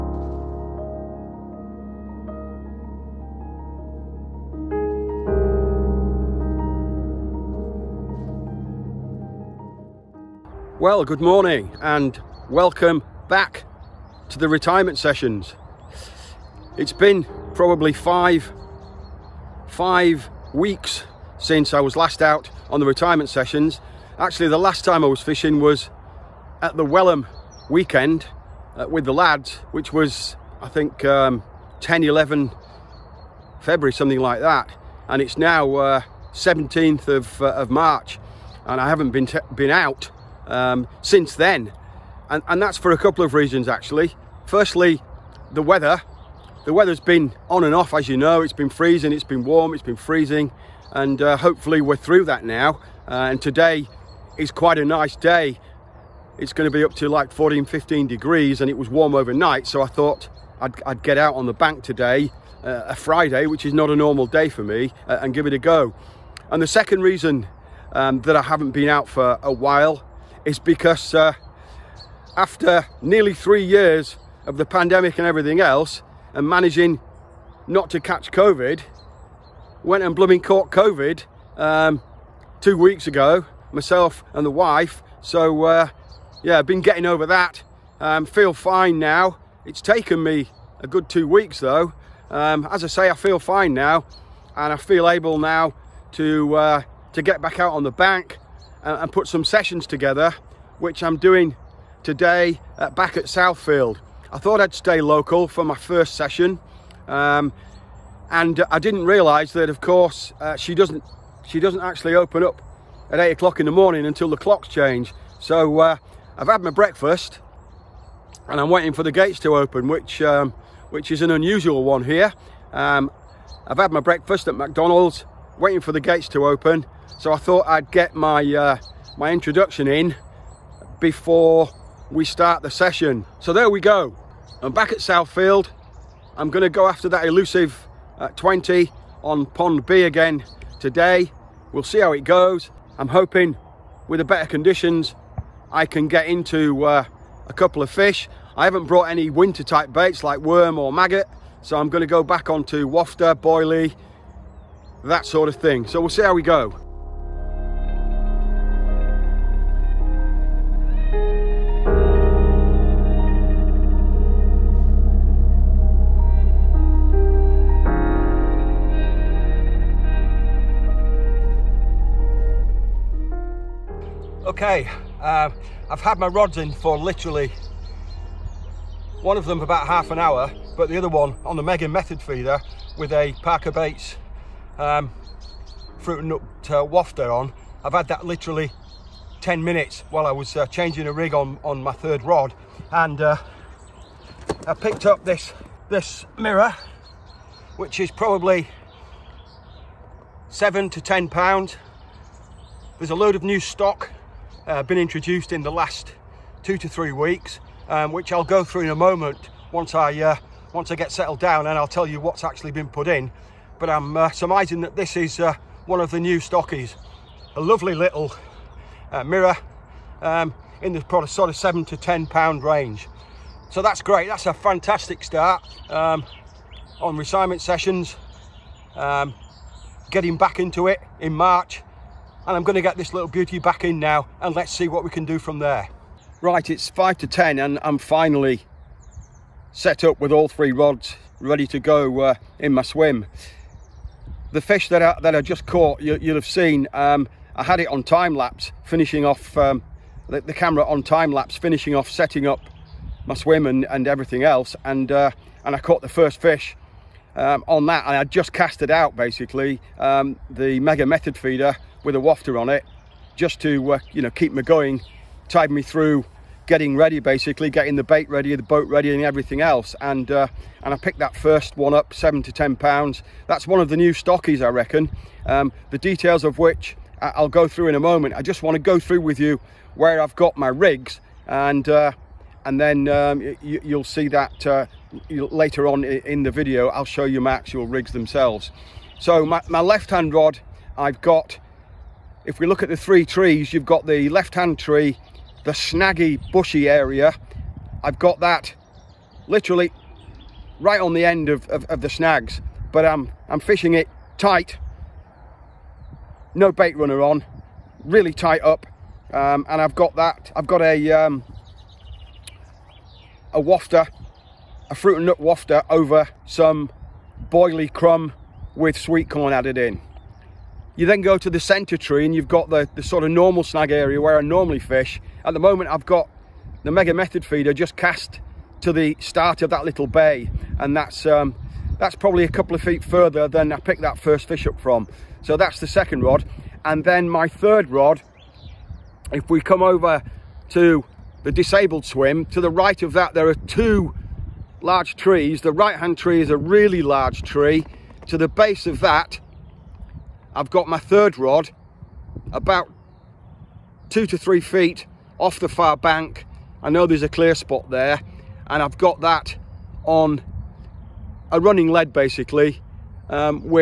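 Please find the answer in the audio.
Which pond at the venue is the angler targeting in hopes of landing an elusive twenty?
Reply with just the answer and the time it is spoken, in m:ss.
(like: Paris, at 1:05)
Pond B, at 2:19.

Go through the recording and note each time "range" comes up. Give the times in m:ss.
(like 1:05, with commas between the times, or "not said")
3:42.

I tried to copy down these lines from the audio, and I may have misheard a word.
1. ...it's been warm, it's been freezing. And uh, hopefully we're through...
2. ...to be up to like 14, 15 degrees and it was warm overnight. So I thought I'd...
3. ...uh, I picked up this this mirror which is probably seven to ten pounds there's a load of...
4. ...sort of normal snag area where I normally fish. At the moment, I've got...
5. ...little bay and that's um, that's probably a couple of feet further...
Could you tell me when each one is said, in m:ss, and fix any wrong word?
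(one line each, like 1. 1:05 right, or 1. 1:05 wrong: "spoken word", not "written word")
1. 0:49 right
2. 0:56 right
3. 3:13 right
4. 5:23 right
5. 5:29 right.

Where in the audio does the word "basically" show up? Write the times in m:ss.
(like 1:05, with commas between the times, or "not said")
4:19, 4:27, 6:02.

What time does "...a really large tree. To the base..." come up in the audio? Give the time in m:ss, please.
5:46.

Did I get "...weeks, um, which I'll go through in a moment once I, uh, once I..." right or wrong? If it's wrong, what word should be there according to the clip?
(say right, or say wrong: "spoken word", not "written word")
right.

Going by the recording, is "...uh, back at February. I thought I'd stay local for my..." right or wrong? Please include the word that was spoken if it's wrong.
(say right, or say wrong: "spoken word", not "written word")
wrong: "Southfield", not "February".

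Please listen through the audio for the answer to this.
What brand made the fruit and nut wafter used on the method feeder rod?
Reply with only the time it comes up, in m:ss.
3:03.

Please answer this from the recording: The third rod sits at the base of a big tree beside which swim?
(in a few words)
the disabled swim.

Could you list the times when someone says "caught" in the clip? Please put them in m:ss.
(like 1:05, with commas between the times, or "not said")
1:20, 4:05, 4:15.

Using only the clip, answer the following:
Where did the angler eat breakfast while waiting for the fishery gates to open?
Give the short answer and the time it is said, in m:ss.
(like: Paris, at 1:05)
McDonald's, at 2:04.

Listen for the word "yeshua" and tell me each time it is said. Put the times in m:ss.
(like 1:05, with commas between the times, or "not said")
not said.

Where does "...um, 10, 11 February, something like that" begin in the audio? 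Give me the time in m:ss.
0:31.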